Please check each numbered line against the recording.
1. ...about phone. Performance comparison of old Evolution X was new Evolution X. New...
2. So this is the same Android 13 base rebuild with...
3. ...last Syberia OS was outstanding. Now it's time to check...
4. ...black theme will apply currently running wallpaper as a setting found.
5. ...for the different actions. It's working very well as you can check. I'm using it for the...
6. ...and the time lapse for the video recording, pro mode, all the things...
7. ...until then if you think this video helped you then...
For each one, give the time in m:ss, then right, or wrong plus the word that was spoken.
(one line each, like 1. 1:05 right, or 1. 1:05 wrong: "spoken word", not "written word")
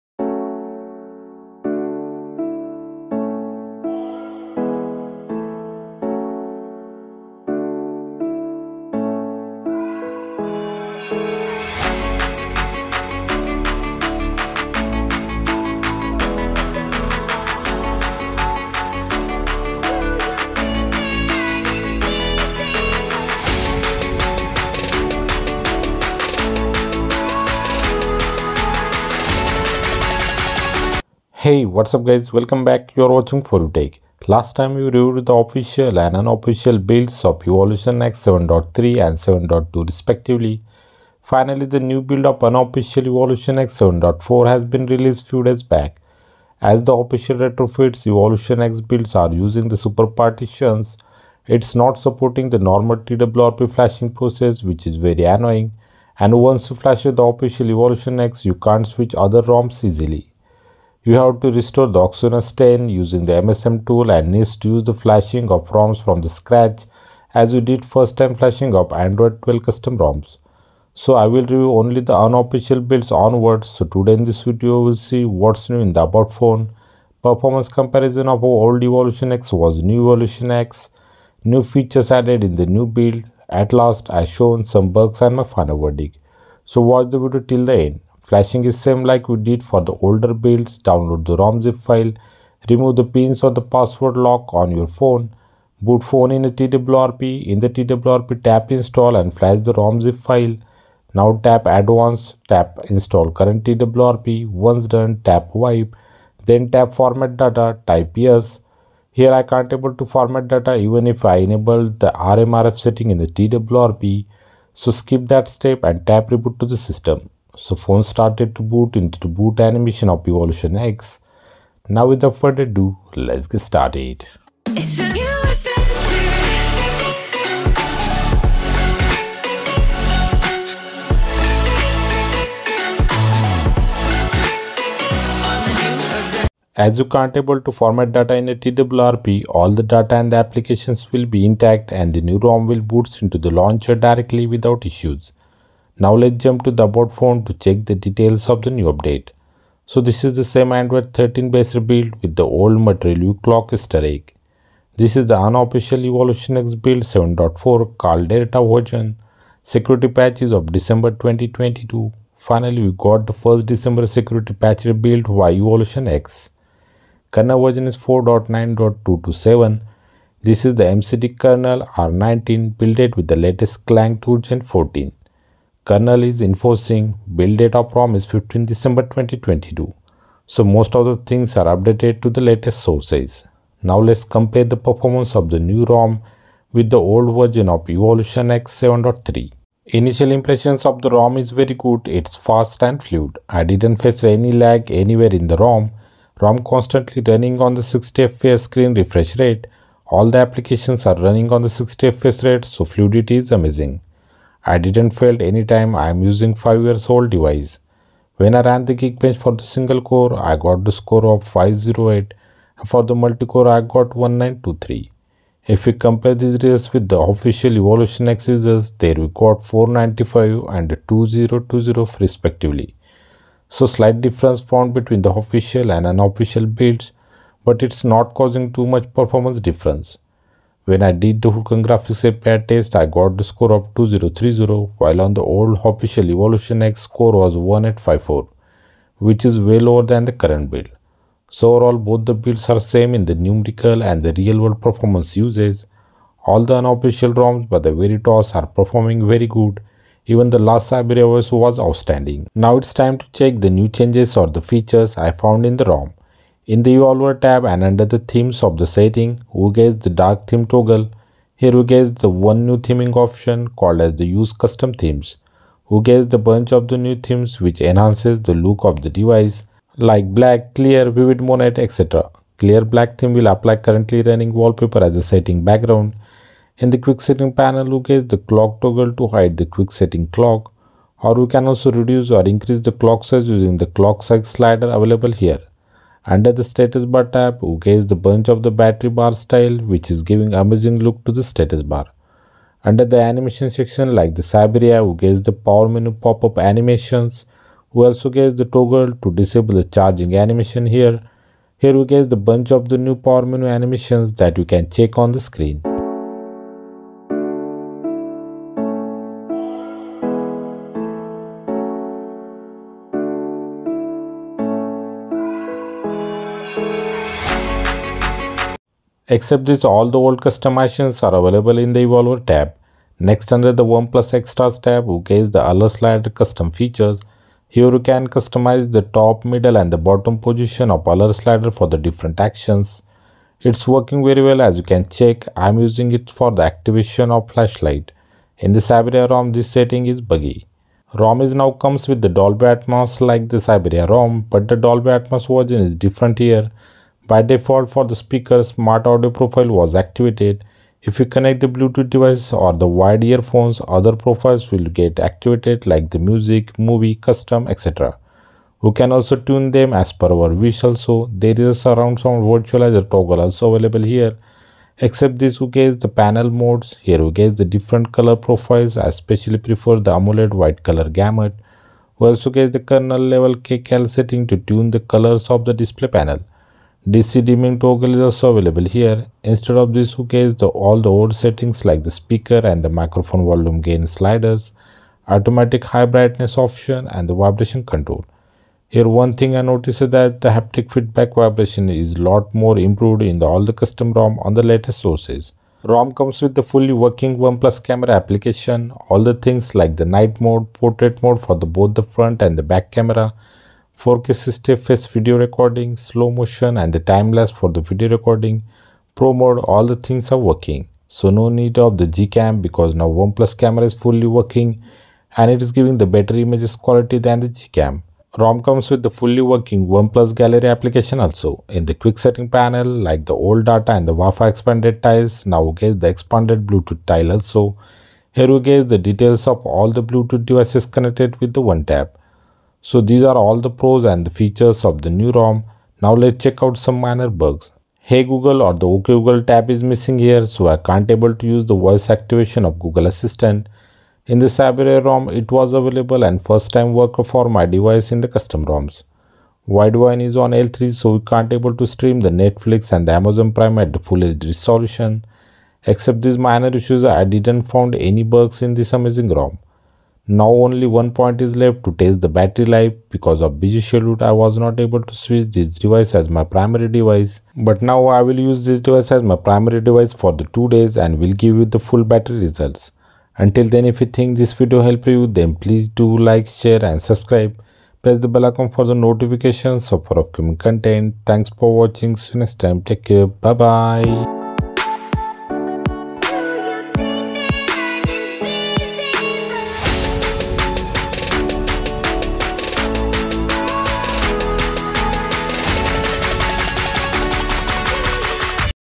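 1. 1:16 right
2. 2:29 right
3. 4:10 right
4. 4:32 wrong: "background", not "found"
5. 5:31 right
6. 6:46 right
7. 7:53 right.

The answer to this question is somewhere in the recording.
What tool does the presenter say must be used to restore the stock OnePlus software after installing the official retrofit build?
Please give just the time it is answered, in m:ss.
1:03.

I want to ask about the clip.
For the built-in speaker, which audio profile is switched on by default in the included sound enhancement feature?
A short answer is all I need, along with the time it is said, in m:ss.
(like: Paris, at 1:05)
smart audio, at 5:48.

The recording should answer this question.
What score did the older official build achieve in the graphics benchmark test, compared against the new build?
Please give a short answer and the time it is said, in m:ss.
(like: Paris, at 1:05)
1854, at 3:57.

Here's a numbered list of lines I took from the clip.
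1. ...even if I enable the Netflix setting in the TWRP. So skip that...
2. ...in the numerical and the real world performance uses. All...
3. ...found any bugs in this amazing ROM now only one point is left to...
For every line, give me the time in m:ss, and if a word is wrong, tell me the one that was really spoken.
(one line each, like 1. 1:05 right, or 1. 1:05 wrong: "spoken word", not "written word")
1. 1:50 wrong: "RMRF", not "Netflix"
2. 4:03 right
3. 7:37 right.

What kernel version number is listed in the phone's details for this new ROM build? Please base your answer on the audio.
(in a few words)
4.9.227.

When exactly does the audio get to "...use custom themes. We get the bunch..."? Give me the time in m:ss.
4:24.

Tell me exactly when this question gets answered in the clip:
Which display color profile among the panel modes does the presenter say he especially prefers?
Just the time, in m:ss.
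6:10.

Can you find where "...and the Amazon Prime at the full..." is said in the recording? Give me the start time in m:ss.
7:32.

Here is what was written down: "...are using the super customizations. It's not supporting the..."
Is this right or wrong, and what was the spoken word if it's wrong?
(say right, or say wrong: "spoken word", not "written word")
wrong: "partitions", not "customizations".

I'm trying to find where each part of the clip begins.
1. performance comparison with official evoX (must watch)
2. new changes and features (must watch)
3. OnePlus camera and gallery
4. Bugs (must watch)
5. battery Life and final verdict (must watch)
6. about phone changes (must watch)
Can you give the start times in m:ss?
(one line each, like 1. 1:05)
1. 3:04
2. 4:12
3. 6:35
4. 7:12
5. 7:40
6. 2:16.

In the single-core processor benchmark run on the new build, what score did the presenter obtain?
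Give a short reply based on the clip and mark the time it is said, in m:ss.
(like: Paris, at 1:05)
508, at 3:31.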